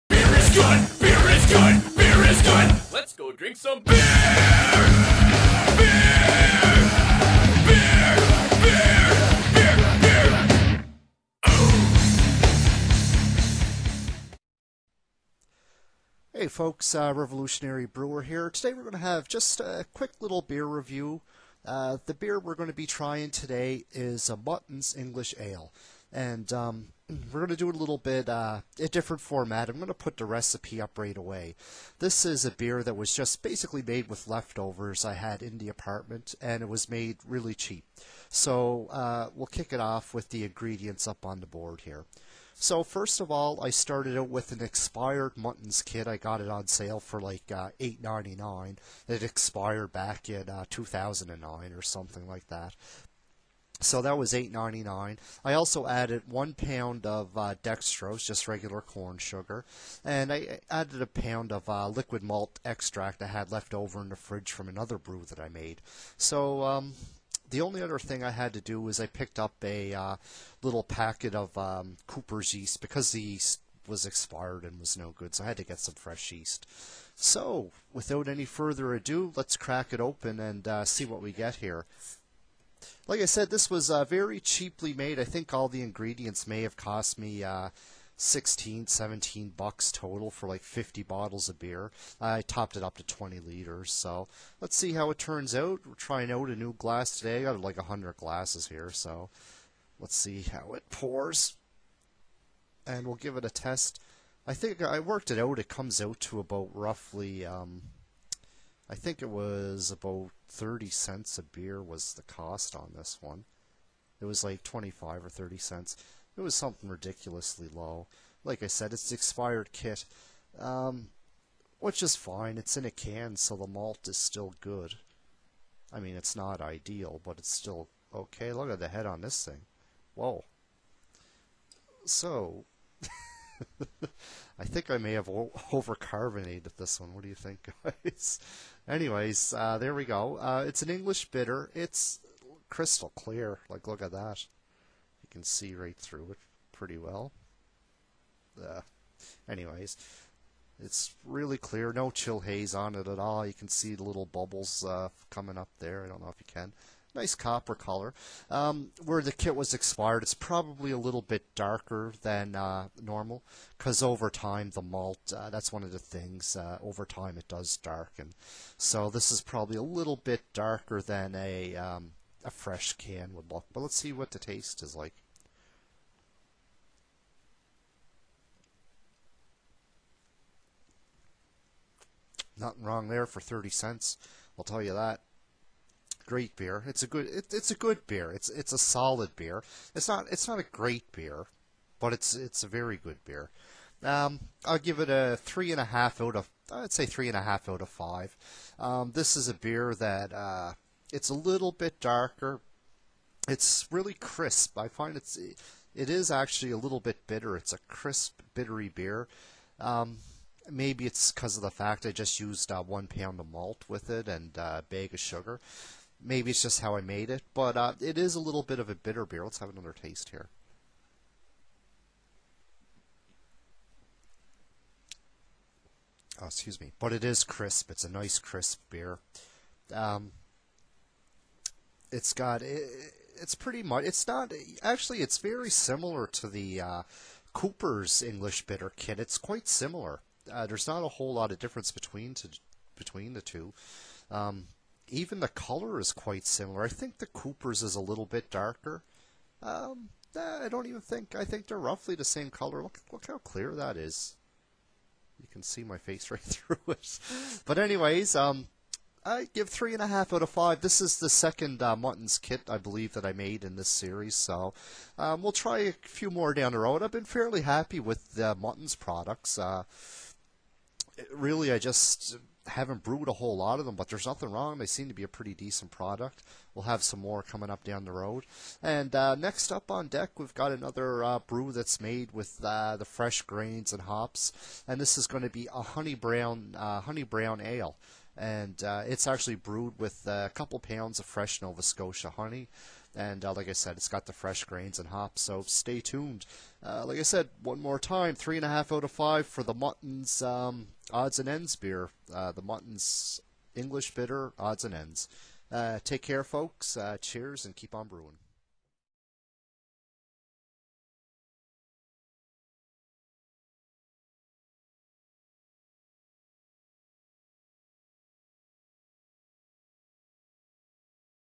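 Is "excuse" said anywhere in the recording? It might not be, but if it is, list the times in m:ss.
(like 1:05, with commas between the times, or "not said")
3:46.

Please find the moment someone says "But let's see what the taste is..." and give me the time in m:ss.
2:53.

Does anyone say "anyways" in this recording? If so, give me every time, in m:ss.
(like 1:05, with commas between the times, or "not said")
2:18, 2:29, 4:17.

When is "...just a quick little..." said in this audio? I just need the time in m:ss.
0:19.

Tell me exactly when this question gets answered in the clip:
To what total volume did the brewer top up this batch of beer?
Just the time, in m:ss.
1:33.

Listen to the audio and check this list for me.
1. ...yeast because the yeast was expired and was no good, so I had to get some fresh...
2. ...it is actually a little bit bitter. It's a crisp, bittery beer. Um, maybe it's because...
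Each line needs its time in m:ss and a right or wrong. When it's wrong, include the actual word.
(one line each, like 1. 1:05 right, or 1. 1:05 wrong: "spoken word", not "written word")
1. 1:12 right
2. 3:25 right.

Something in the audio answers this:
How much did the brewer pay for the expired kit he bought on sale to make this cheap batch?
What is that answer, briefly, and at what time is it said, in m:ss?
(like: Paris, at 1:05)
$8.99, at 0:54.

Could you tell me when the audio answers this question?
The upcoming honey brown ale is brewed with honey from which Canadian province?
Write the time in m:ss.
4:51.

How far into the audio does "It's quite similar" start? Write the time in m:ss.
3:59.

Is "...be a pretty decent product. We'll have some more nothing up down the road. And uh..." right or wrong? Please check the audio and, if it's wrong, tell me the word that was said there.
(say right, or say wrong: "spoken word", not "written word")
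wrong: "coming", not "nothing".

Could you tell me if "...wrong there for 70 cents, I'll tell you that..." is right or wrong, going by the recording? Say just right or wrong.
wrong.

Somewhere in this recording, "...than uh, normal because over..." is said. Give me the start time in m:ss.
2:42.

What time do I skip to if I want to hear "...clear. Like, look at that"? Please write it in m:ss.
2:23.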